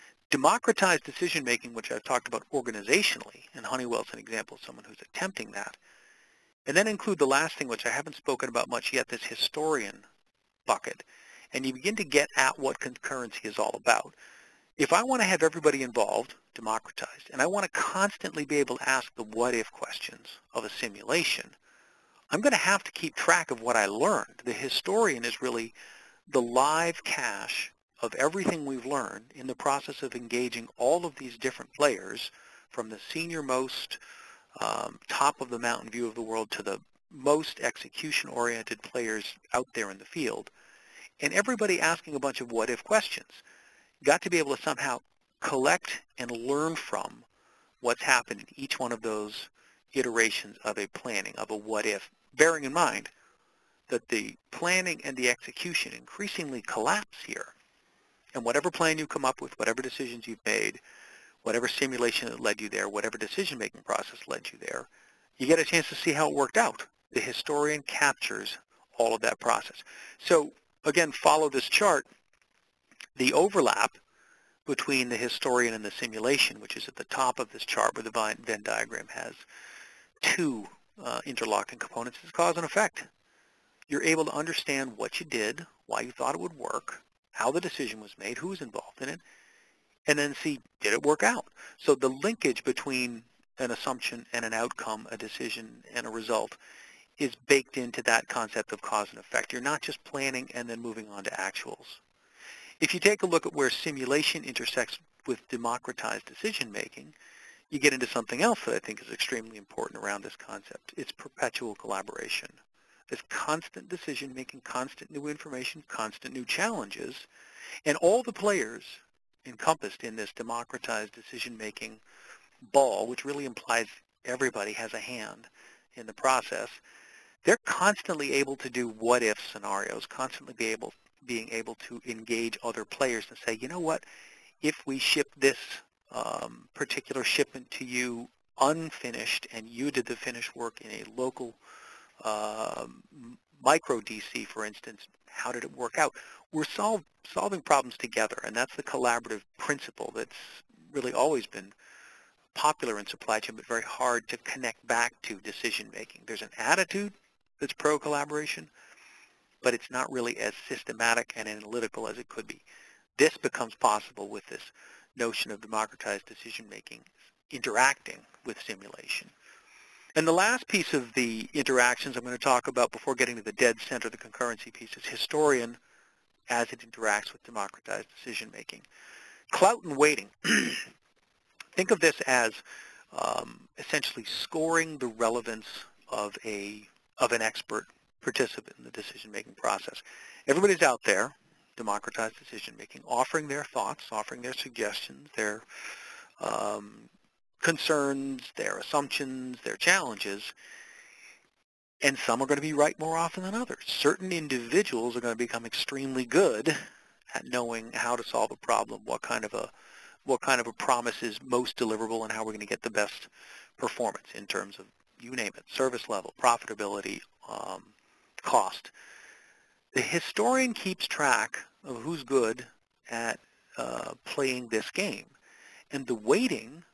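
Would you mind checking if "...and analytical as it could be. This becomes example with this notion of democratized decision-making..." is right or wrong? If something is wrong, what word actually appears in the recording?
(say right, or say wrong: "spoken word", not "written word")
wrong: "possible", not "example".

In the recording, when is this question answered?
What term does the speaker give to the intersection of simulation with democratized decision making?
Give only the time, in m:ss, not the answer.
1:51.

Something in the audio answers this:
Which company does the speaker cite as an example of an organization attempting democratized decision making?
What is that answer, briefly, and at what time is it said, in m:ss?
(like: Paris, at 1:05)
Honeywell, at 0:03.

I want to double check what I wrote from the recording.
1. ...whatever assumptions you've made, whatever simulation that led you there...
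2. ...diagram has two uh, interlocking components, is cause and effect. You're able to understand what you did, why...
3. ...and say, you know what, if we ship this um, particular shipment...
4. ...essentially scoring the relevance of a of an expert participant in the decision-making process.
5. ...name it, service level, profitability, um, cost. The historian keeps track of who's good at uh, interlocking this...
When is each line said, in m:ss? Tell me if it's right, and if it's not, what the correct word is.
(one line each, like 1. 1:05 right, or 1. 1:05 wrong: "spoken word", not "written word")
1. 0:59 wrong: "decisions", not "assumptions"
2. 1:18 right
3. 2:13 right
4. 3:03 right
5. 3:35 wrong: "playing", not "interlocking".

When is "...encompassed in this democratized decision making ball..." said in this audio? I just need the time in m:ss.
1:59.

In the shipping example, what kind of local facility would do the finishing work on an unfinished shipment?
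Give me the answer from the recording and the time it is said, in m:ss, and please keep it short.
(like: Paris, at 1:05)
Micro DC, at 2:23.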